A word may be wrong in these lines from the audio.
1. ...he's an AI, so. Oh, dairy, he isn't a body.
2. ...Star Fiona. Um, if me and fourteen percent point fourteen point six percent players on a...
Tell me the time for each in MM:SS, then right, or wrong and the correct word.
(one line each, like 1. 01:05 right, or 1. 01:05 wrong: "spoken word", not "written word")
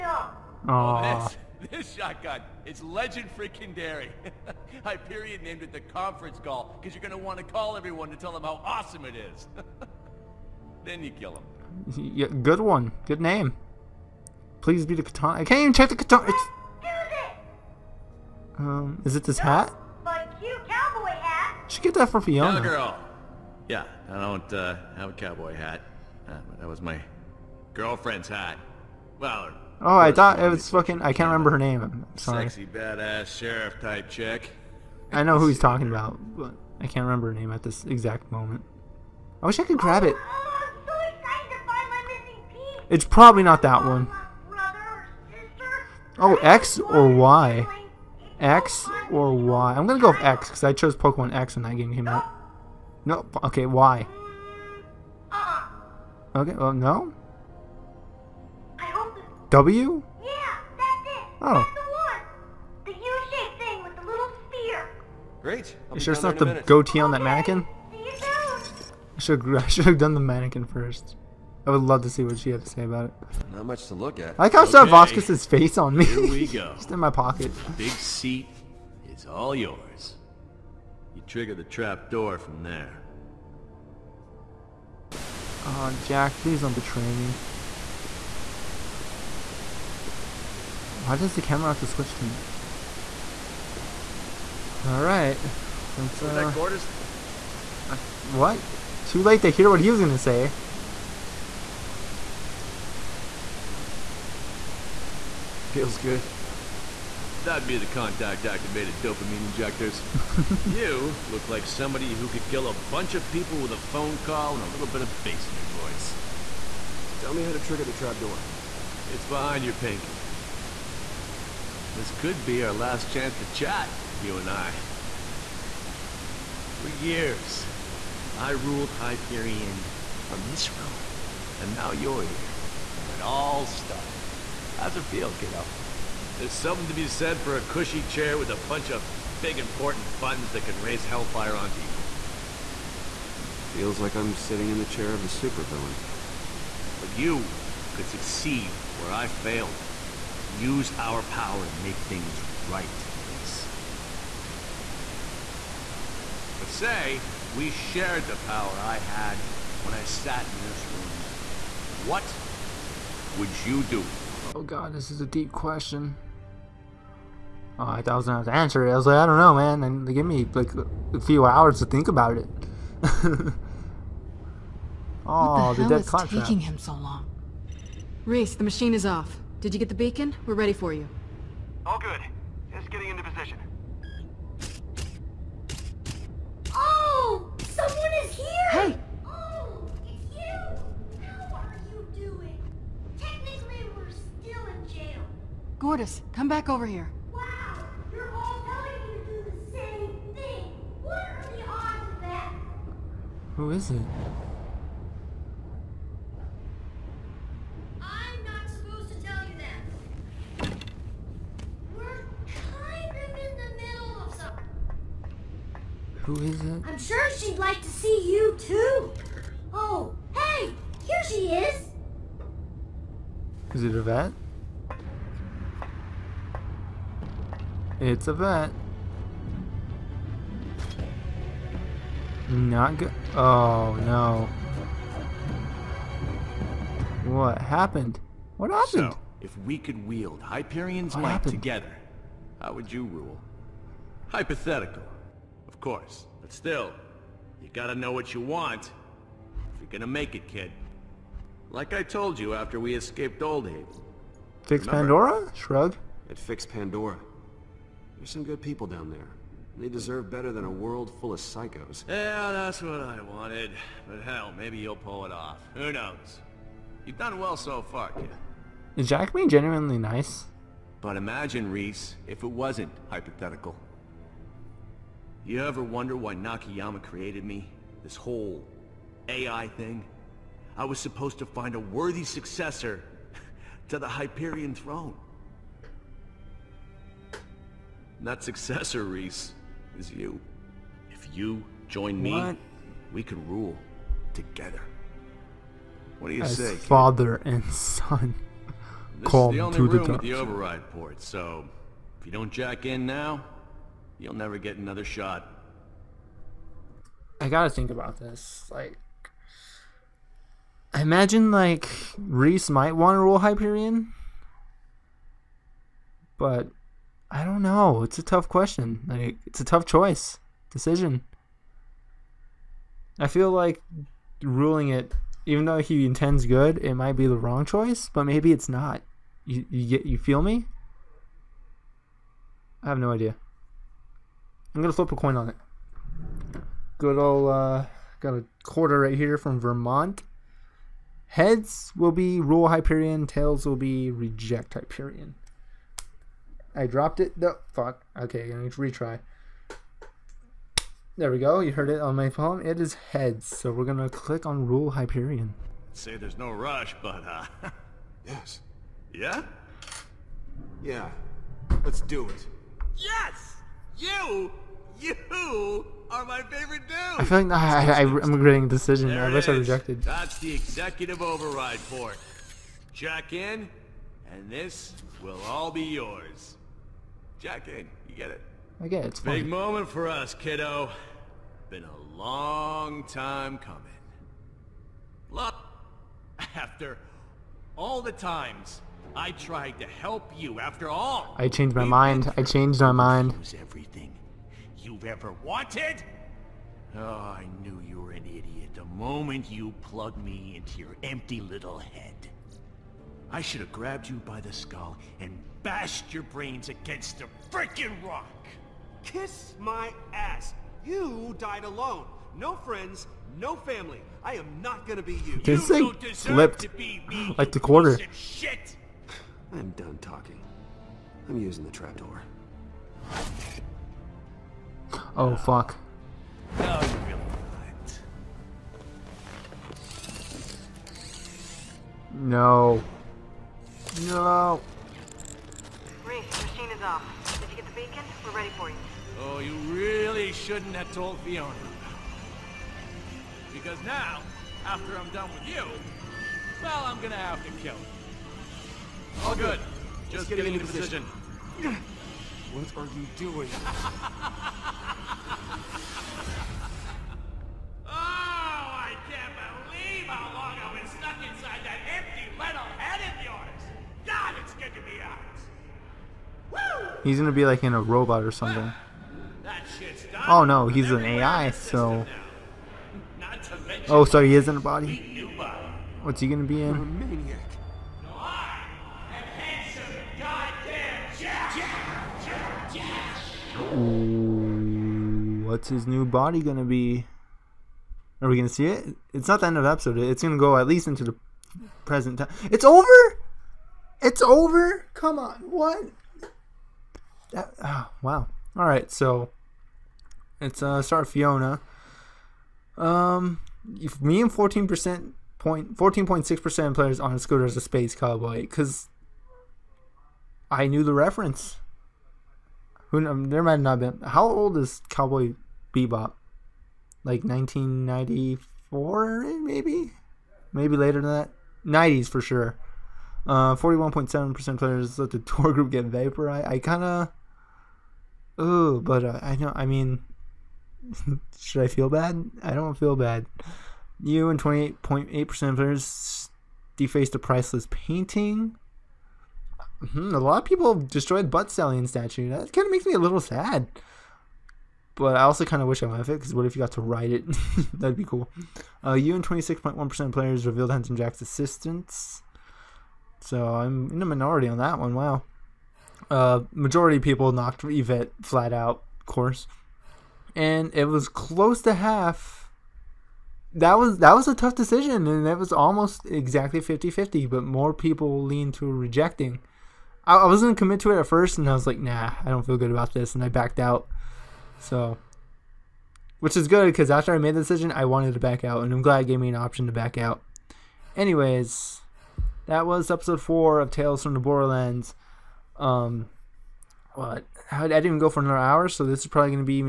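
1. 07:50 wrong: "sorry", not "dairy"
2. 08:20 right.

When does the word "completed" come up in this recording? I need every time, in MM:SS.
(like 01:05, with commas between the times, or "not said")
not said.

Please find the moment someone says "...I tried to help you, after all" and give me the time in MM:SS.
06:29.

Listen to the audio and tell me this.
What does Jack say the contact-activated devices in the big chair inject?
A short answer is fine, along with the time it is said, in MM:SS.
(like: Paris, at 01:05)
Dopamine, at 01:48.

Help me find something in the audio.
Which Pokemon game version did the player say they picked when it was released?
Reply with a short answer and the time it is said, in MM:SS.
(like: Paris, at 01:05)
Pokemon X, at 00:50.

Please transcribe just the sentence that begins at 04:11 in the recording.
Like I told you after we escaped Old Haven.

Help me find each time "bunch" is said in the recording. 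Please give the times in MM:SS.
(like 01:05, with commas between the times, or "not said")
01:52, 02:18.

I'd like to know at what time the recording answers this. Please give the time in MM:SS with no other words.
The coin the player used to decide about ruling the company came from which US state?
05:39.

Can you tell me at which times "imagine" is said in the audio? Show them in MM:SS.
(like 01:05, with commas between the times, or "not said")
04:31, 05:11.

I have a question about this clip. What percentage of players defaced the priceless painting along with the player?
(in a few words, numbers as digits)
28.8%.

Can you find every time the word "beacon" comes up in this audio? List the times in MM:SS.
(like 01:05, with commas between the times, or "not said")
02:59, 07:17.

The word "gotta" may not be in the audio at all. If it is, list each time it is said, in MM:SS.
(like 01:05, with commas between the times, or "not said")
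04:07, 05:07.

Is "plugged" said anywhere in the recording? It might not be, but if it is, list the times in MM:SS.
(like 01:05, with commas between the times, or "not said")
06:39.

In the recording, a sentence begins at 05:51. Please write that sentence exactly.
You heard it on my phone.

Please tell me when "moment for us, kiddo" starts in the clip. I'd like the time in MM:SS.
06:19.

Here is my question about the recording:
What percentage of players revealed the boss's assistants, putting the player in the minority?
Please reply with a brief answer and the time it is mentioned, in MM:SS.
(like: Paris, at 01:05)
26.1%, at 09:09.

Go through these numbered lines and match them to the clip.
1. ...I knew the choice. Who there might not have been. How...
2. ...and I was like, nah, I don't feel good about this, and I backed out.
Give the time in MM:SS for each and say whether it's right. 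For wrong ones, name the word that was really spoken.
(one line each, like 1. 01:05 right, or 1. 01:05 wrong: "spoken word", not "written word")
1. 08:30 wrong: "reference", not "choice"
2. 09:31 right.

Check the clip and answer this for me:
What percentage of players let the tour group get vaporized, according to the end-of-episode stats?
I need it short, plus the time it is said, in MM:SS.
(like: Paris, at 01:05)
41.7%, at 08:43.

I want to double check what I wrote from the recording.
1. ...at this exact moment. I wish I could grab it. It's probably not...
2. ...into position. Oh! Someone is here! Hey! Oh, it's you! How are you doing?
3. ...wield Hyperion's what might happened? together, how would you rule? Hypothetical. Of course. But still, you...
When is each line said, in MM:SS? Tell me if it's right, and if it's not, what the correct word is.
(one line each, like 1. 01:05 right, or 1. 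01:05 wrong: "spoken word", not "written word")
1. 00:37 right
2. 03:03 right
3. 04:00 right.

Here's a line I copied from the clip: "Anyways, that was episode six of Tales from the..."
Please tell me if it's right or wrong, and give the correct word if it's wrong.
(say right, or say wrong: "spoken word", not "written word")
wrong: "four", not "six".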